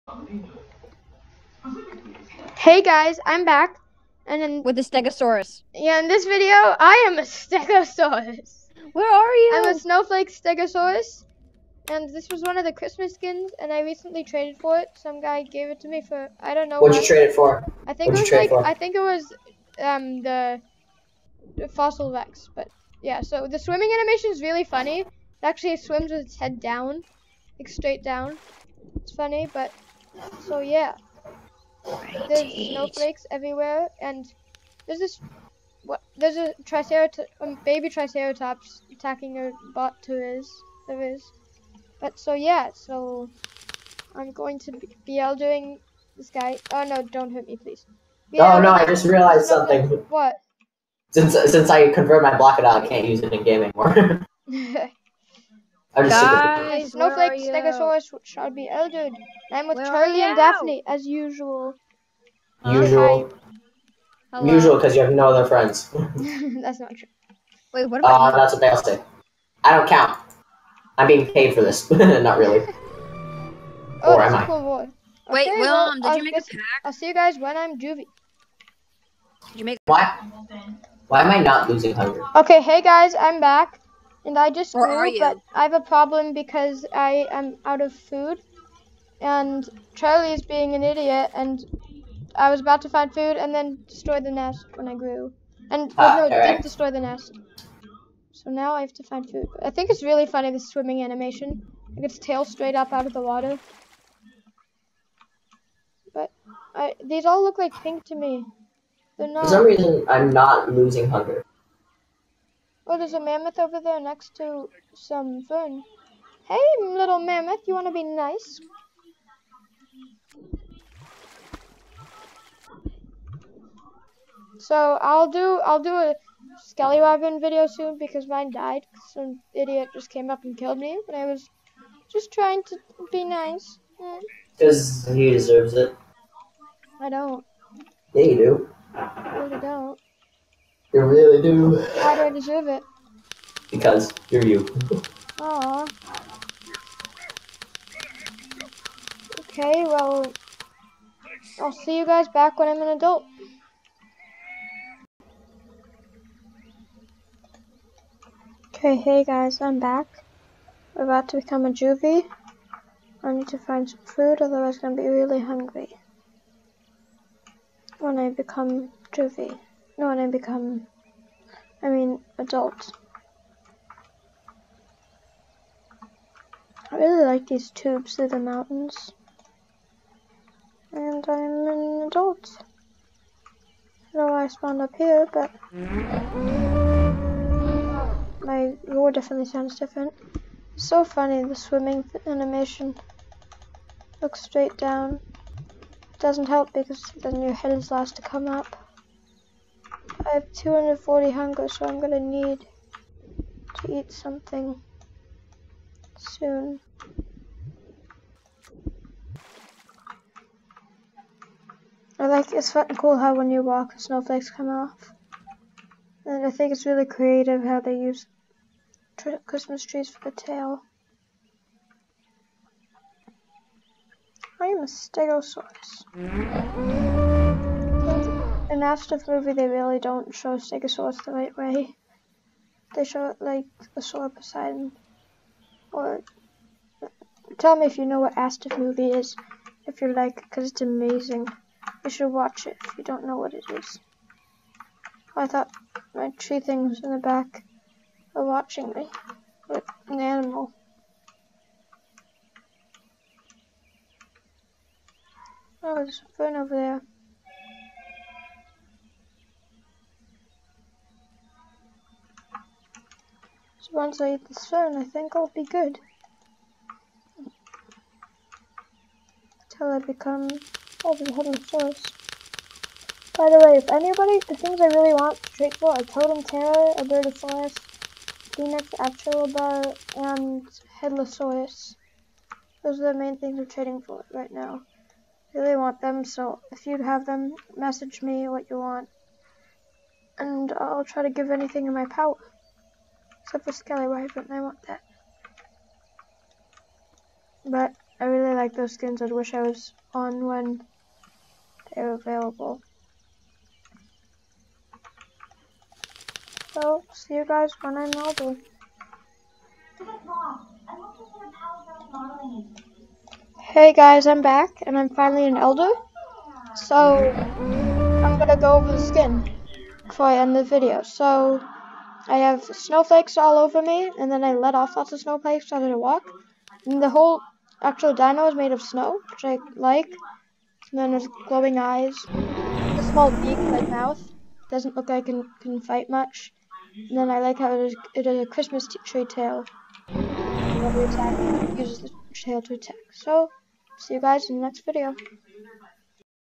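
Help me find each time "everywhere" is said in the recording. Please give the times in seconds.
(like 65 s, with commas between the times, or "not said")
33 s.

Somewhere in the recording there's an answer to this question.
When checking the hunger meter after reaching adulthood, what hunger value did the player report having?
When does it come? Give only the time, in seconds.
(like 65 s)
200 s.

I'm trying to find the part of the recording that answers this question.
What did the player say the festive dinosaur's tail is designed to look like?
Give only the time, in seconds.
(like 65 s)
219 s.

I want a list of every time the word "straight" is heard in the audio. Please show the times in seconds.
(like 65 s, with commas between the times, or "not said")
27 s, 102 s, 194 s.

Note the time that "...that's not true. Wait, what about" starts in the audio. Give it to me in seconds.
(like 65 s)
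66 s.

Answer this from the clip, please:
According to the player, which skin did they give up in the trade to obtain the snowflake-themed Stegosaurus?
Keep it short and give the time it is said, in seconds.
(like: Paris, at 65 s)
Fossil Rex, at 21 s.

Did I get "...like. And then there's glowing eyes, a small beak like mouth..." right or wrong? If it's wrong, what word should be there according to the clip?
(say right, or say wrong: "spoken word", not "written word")
right.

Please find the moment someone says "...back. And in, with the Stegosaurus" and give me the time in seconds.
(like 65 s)
3 s.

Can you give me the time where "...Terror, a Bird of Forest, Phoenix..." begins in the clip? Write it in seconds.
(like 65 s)
276 s.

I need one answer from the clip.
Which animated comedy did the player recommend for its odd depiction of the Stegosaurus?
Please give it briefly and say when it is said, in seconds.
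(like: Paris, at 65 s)
asdf movie, at 238 s.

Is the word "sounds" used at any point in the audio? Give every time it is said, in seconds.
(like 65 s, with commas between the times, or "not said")
189 s.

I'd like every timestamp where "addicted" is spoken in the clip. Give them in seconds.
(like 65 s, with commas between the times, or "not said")
not said.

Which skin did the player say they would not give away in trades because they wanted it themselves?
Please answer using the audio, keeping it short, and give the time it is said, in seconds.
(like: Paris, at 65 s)
Scallywag, at 293 s.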